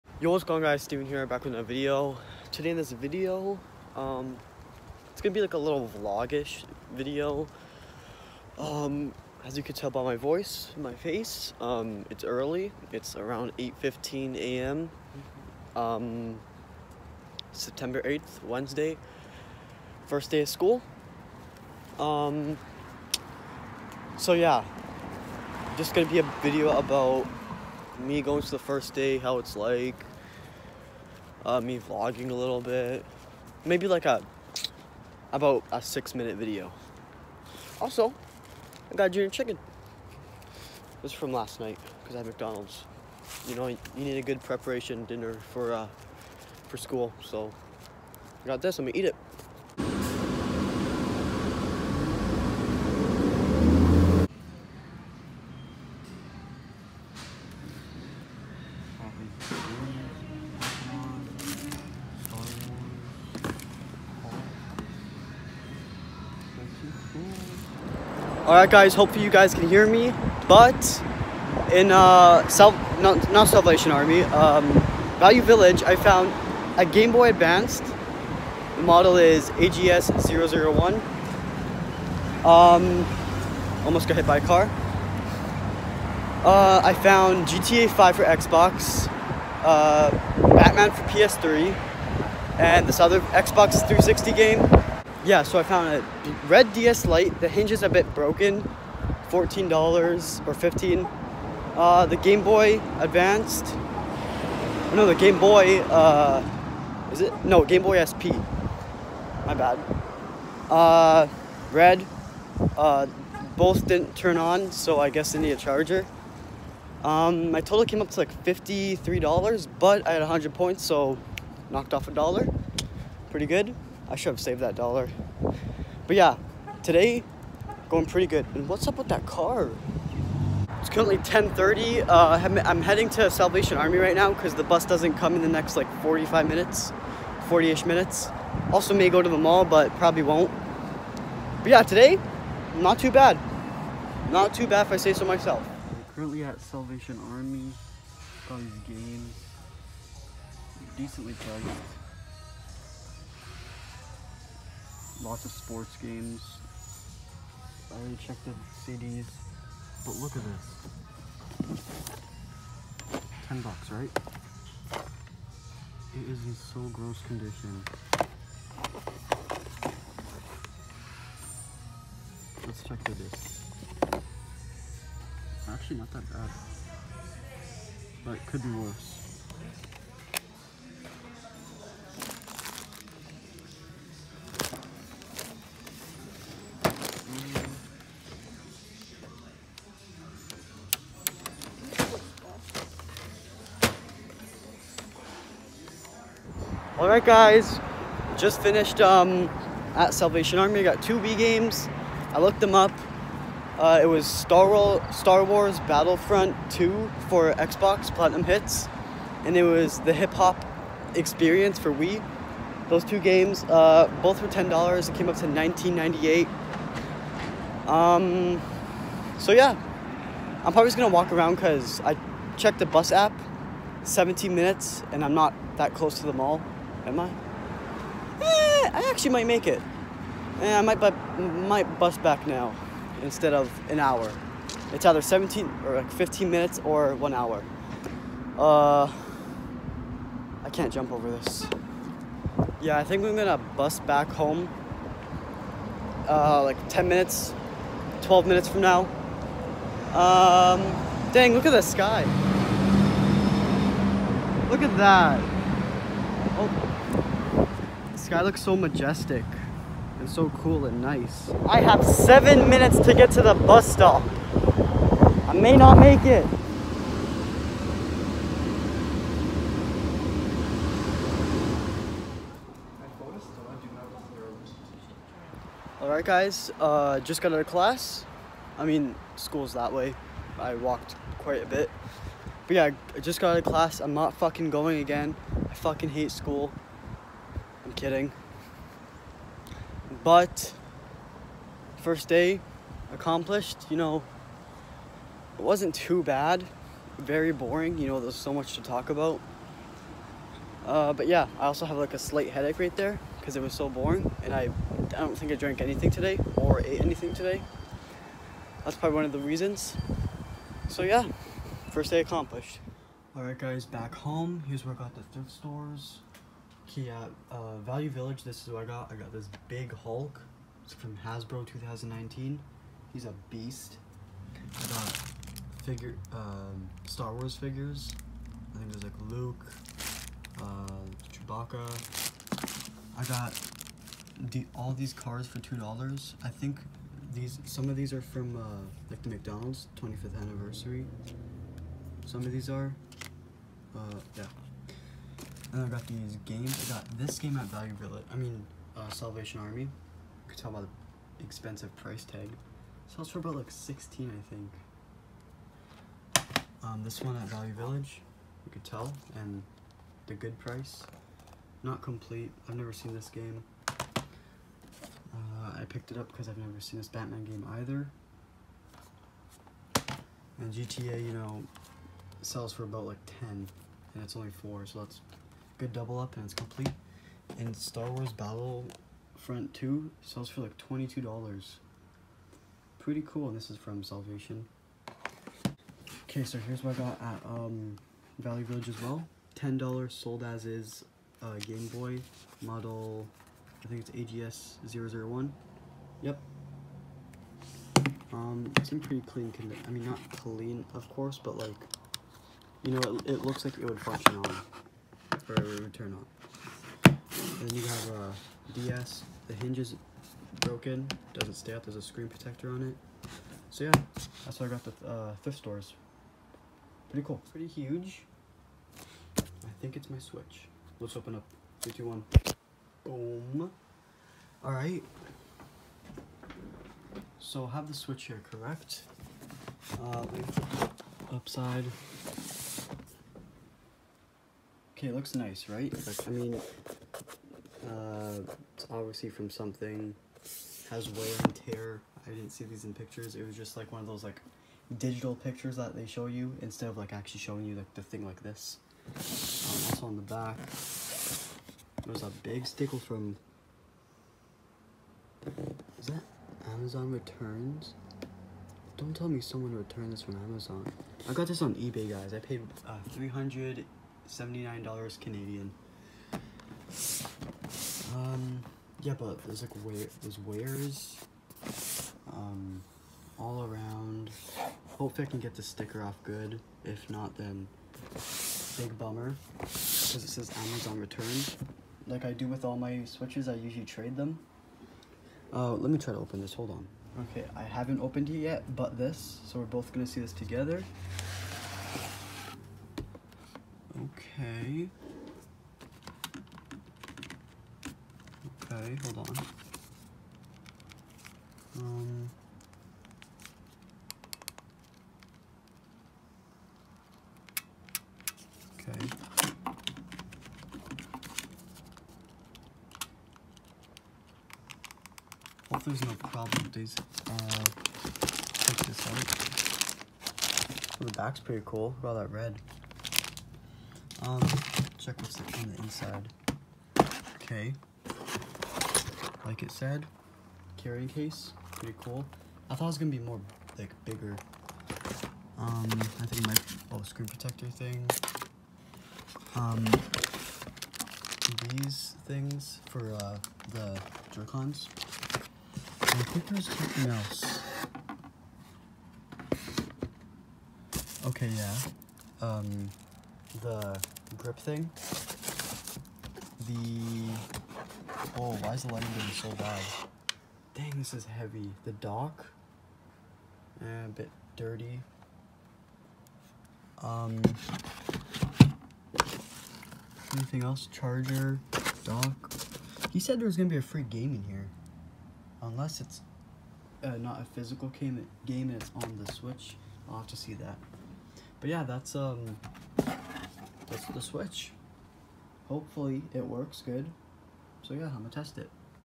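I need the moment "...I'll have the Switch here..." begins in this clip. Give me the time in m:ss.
7:07.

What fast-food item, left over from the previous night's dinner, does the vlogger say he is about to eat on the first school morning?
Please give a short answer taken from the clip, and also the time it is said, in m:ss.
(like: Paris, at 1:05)
junior chicken, at 0:39.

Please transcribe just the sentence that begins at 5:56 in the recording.
Um, this one at Value Village.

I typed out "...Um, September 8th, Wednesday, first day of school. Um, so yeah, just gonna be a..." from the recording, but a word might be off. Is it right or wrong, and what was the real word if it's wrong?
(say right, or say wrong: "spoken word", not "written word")
right.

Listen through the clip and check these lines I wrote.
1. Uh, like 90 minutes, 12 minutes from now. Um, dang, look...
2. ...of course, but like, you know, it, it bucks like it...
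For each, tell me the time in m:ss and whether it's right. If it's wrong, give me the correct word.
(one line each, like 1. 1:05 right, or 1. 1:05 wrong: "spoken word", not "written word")
1. 4:06 wrong: "10", not "90"
2. 6:40 wrong: "looks", not "bucks".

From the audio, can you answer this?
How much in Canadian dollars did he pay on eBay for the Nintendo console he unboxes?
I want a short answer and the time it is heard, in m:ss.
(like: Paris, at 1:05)
$379, at 7:43.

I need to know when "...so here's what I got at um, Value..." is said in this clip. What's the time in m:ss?
6:26.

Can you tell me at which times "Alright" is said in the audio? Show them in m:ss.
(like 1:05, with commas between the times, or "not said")
1:08, 4:36, 5:13.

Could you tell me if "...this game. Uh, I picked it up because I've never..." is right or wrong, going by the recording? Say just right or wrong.
right.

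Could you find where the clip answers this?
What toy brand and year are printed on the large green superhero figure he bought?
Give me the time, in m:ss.
5:21.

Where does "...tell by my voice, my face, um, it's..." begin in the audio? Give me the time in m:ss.
0:09.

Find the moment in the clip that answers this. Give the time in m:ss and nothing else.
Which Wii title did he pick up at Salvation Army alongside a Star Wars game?
3:30.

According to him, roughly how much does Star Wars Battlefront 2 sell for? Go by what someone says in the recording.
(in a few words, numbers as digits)
$22.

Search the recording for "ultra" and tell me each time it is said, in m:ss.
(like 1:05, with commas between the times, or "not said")
not said.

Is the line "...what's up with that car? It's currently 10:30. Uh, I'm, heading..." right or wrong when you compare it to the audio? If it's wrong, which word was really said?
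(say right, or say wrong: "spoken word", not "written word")
right.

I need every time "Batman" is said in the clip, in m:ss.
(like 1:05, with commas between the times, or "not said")
1:30, 6:07.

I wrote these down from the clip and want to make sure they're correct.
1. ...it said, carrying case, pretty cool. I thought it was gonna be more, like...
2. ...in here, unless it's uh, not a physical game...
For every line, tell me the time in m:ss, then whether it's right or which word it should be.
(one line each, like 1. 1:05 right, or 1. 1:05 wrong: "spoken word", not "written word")
1. 8:49 right
2. 9:34 right.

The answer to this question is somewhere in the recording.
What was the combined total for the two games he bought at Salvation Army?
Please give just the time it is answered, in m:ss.
3:35.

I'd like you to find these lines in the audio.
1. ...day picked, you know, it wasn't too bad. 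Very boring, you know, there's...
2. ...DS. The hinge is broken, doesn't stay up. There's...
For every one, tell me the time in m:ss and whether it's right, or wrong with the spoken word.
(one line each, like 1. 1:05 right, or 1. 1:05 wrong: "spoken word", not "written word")
1. 4:52 wrong: "accomplished", not "picked"
2. 6:48 right.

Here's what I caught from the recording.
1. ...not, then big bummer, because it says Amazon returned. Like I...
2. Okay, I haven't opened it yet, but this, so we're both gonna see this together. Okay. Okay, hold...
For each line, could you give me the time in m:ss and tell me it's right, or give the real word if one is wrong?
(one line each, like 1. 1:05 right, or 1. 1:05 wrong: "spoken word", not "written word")
1. 7:57 right
2. 8:07 right.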